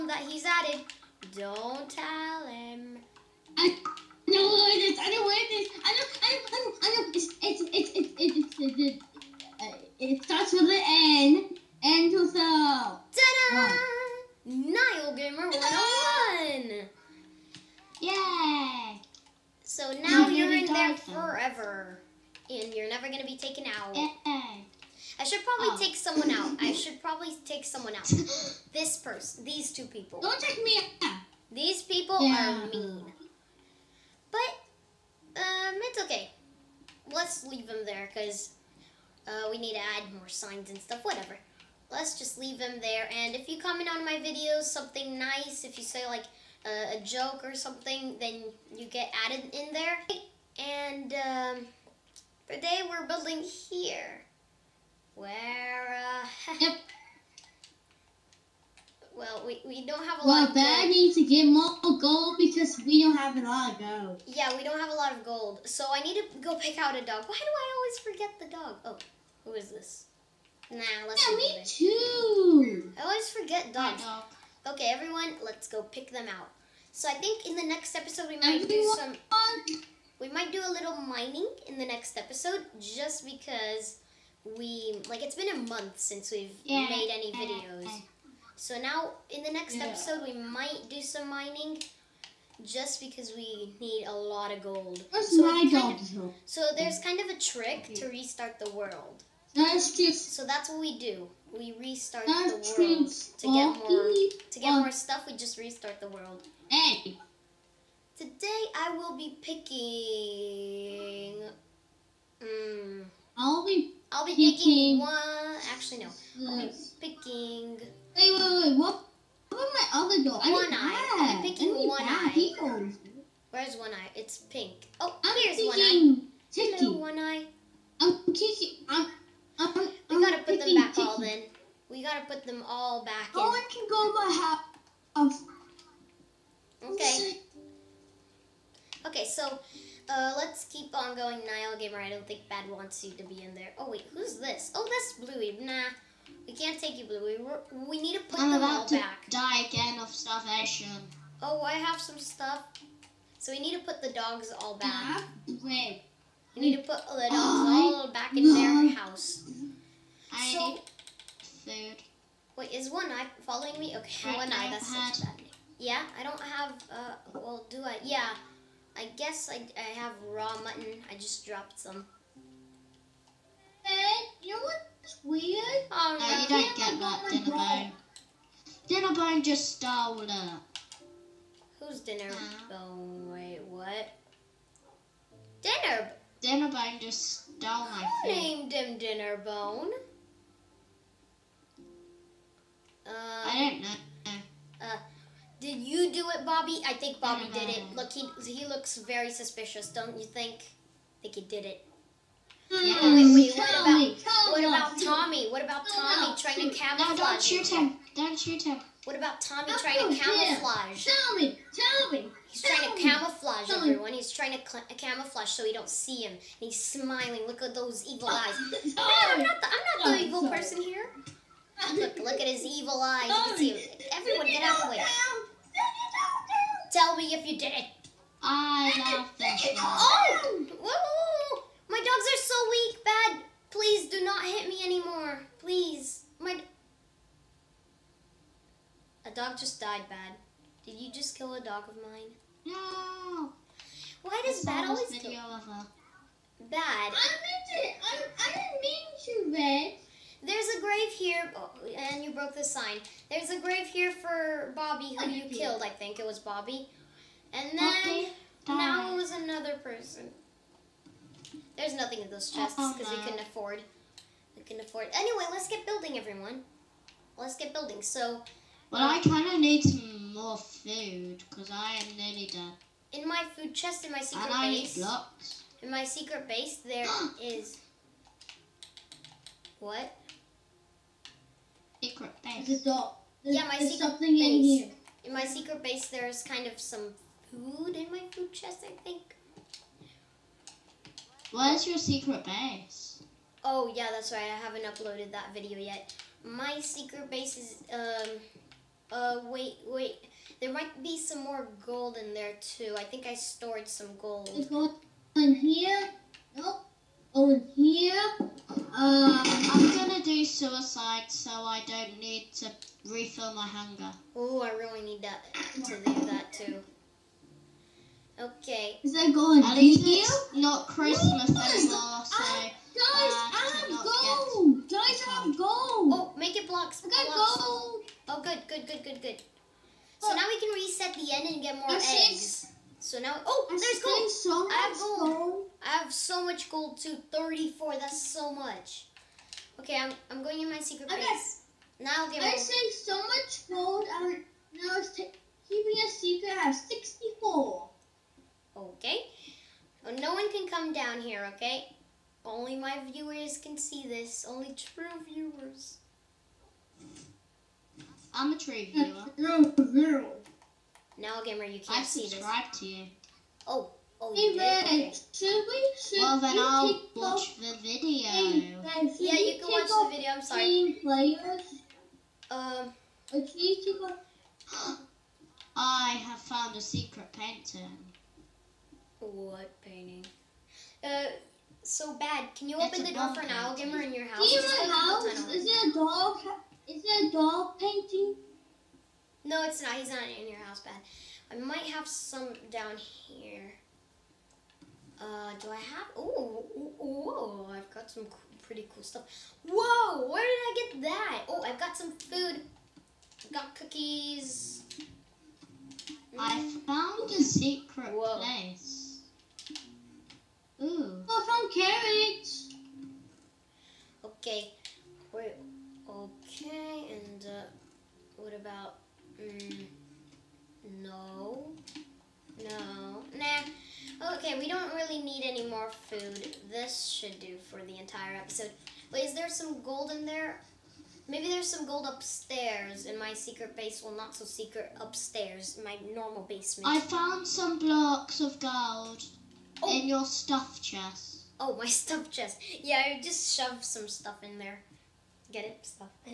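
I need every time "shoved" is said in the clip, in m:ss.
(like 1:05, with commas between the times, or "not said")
7:23.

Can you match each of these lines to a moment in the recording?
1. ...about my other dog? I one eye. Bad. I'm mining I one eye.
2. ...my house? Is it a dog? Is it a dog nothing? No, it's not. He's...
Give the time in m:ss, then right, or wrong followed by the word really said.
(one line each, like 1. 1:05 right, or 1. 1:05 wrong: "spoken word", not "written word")
1. 1:59 wrong: "picking", not "mining"
2. 6:24 wrong: "painting", not "nothing".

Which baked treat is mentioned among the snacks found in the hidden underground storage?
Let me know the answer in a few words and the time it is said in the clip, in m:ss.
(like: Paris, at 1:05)
cookies, at 6:43.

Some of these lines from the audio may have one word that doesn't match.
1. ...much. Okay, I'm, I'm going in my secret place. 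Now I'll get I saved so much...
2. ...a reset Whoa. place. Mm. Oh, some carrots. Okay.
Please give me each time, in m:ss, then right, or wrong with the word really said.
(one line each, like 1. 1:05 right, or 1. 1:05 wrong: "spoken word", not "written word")
1. 5:38 right
2. 6:47 wrong: "secret", not "reset".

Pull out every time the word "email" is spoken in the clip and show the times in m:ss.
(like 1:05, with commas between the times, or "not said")
not said.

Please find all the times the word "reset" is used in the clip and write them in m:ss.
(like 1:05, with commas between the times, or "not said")
5:30.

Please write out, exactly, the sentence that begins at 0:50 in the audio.
And, um, today we're building here.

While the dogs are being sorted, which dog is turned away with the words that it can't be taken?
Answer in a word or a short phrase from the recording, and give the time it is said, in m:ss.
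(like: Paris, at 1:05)
Bluey, at 2:24.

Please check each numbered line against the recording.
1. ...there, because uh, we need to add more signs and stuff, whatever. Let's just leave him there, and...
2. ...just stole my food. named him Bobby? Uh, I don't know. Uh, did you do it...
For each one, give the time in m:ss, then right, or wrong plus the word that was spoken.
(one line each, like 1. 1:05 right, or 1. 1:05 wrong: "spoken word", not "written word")
1. 0:37 right
2. 3:06 wrong: "Dinnerbone", not "Bobby".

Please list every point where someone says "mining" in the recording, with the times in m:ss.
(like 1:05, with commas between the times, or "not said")
1:20, 1:31.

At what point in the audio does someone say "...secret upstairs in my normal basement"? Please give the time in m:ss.
7:14.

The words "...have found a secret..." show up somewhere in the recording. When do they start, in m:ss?
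6:16.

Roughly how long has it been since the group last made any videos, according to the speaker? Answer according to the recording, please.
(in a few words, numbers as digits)
a month.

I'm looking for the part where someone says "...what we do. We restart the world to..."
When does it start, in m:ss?
1:40.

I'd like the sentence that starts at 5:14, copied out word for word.
Oh, I really need that to do that, too.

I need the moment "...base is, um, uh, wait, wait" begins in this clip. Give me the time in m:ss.
4:57.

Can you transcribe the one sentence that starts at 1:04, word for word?
Yeah, we don't have a lot of gold.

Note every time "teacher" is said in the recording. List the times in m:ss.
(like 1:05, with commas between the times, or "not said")
not said.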